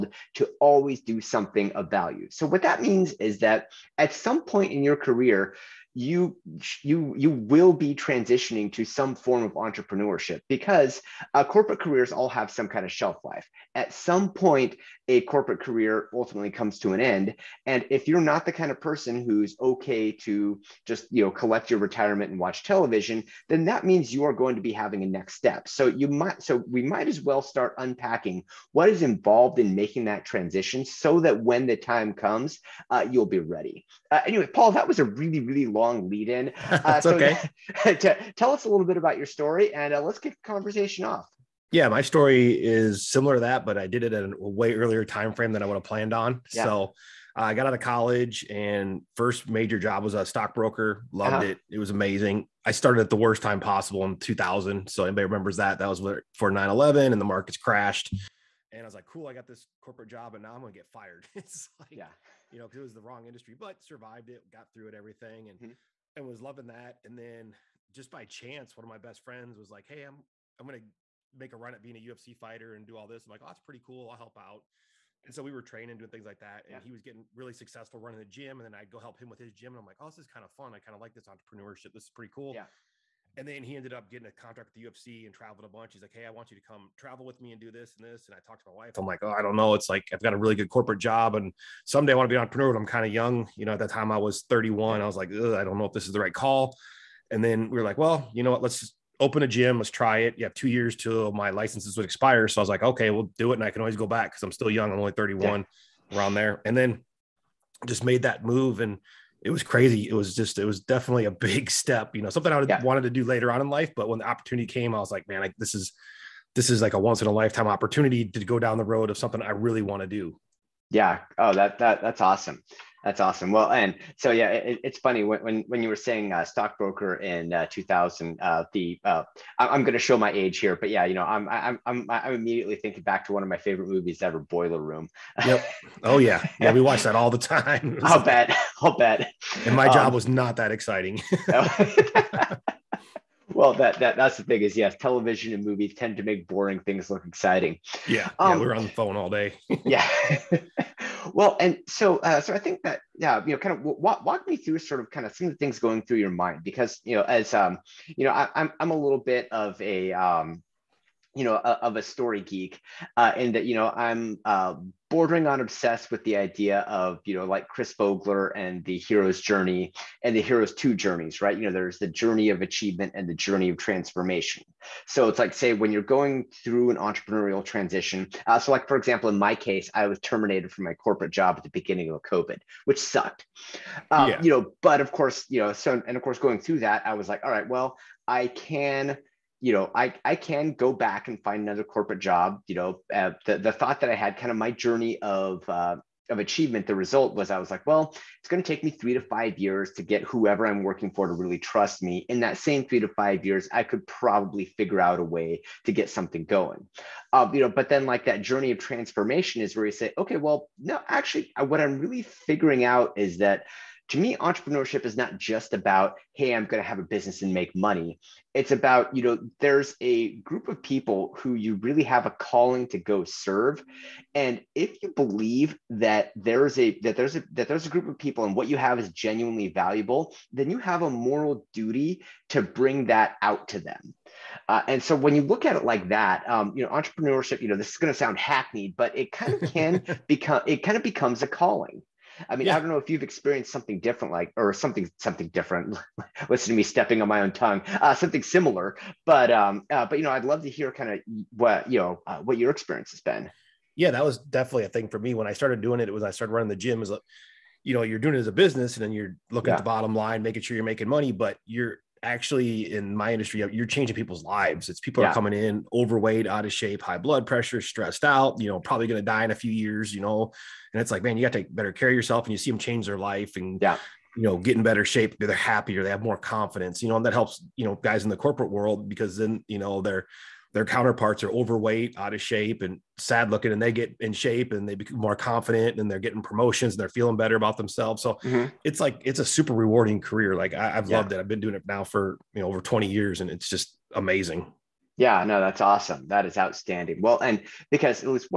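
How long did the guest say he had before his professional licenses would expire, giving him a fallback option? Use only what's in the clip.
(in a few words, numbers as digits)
2 years.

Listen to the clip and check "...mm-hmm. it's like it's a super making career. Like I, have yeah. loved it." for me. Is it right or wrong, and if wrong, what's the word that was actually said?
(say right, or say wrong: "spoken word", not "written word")
wrong: "rewarding", not "making".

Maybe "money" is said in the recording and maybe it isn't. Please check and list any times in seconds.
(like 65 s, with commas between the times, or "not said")
217 s, 261 s.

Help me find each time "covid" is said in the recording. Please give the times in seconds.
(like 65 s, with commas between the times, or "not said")
182 s.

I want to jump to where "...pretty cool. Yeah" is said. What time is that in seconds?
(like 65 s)
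82 s.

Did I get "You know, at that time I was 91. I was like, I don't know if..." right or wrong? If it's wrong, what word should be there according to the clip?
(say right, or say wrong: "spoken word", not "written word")
wrong: "31", not "91".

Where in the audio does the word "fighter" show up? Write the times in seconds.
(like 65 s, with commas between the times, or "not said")
72 s.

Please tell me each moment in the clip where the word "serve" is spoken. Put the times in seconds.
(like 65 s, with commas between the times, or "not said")
223 s.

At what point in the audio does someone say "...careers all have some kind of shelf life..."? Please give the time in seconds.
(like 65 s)
11 s.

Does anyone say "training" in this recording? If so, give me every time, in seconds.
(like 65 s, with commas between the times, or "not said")
75 s.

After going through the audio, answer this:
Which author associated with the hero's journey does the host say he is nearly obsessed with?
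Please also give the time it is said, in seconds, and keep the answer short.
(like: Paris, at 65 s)
Chris Vogler, at 167 s.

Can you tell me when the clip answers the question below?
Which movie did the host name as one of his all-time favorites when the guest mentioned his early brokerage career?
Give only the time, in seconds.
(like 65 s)
134 s.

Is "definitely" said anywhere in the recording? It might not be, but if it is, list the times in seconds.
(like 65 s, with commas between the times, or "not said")
110 s, 254 s.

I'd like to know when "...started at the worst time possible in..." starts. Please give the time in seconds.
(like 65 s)
52 s.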